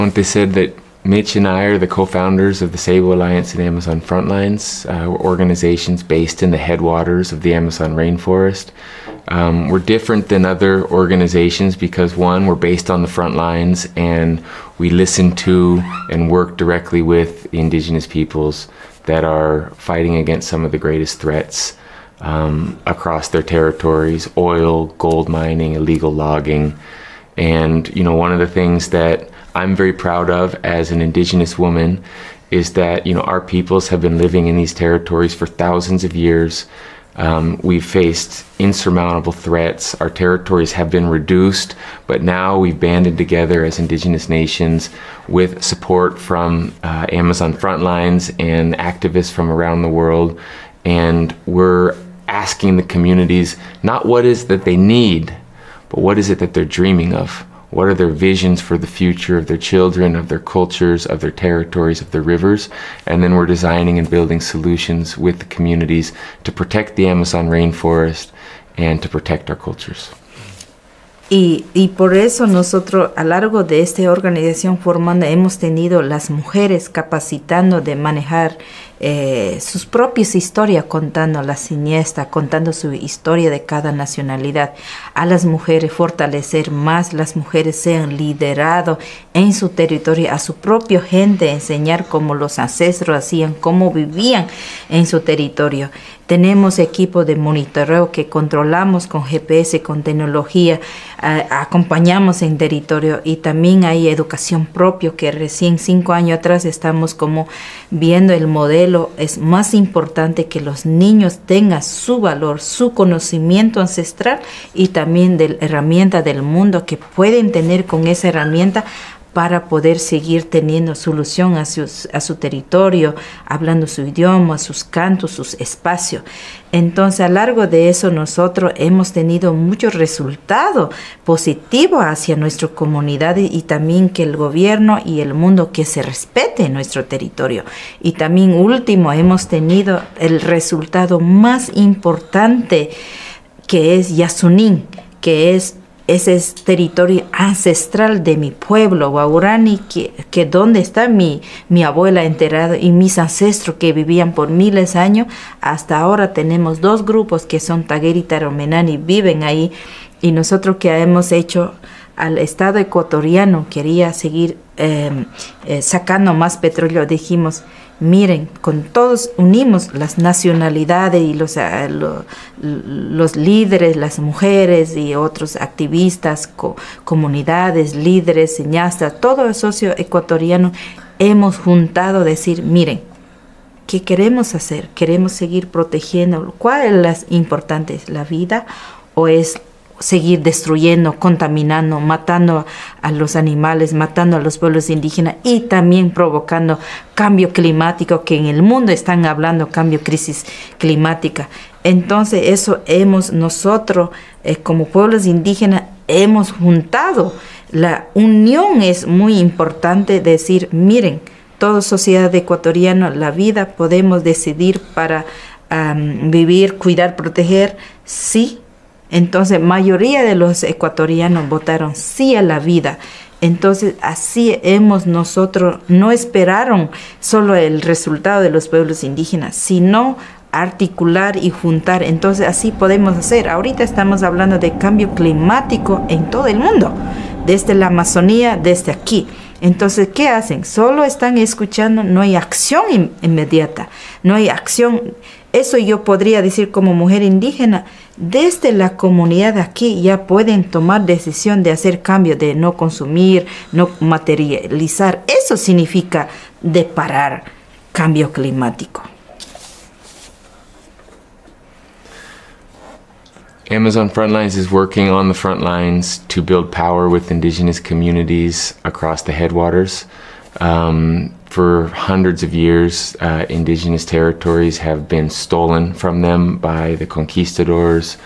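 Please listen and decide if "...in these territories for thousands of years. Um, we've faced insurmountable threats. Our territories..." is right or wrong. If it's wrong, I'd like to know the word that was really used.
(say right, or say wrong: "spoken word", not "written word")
right.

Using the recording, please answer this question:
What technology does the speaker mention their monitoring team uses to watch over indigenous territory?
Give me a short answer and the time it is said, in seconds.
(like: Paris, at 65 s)
GPS, at 99 s.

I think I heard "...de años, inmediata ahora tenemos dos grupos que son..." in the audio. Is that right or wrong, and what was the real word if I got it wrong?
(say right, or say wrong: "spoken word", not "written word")
wrong: "hasta", not "inmediata".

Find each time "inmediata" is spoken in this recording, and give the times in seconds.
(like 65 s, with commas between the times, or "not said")
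243 s.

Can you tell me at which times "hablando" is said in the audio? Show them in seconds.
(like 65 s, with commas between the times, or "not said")
123 s, 199 s, 234 s.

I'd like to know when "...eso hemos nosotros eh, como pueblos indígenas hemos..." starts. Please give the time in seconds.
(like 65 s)
202 s.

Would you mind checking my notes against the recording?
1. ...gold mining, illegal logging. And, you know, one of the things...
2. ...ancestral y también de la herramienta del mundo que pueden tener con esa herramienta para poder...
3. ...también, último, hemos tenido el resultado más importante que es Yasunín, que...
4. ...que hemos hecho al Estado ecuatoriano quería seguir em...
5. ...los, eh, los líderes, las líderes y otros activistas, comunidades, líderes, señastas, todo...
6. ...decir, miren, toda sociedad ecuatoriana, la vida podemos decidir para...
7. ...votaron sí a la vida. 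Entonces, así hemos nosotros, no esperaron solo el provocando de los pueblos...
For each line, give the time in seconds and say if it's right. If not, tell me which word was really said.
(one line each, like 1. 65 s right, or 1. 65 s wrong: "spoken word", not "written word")
1. 24 s right
2. 113 s right
3. 138 s right
4. 160 s right
5. 171 s wrong: "mujeres", not "líderes"
6. 210 s right
7. 221 s wrong: "resultado", not "provocando".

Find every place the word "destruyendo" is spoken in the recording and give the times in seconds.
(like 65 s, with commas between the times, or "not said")
190 s.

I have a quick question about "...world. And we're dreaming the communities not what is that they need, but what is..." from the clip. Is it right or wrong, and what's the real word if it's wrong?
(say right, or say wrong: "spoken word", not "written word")
wrong: "asking", not "dreaming".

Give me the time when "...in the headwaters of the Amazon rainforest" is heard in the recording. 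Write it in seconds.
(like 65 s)
6 s.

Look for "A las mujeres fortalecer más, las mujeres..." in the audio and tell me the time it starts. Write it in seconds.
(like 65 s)
85 s.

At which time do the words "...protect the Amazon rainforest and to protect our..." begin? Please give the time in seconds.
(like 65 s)
66 s.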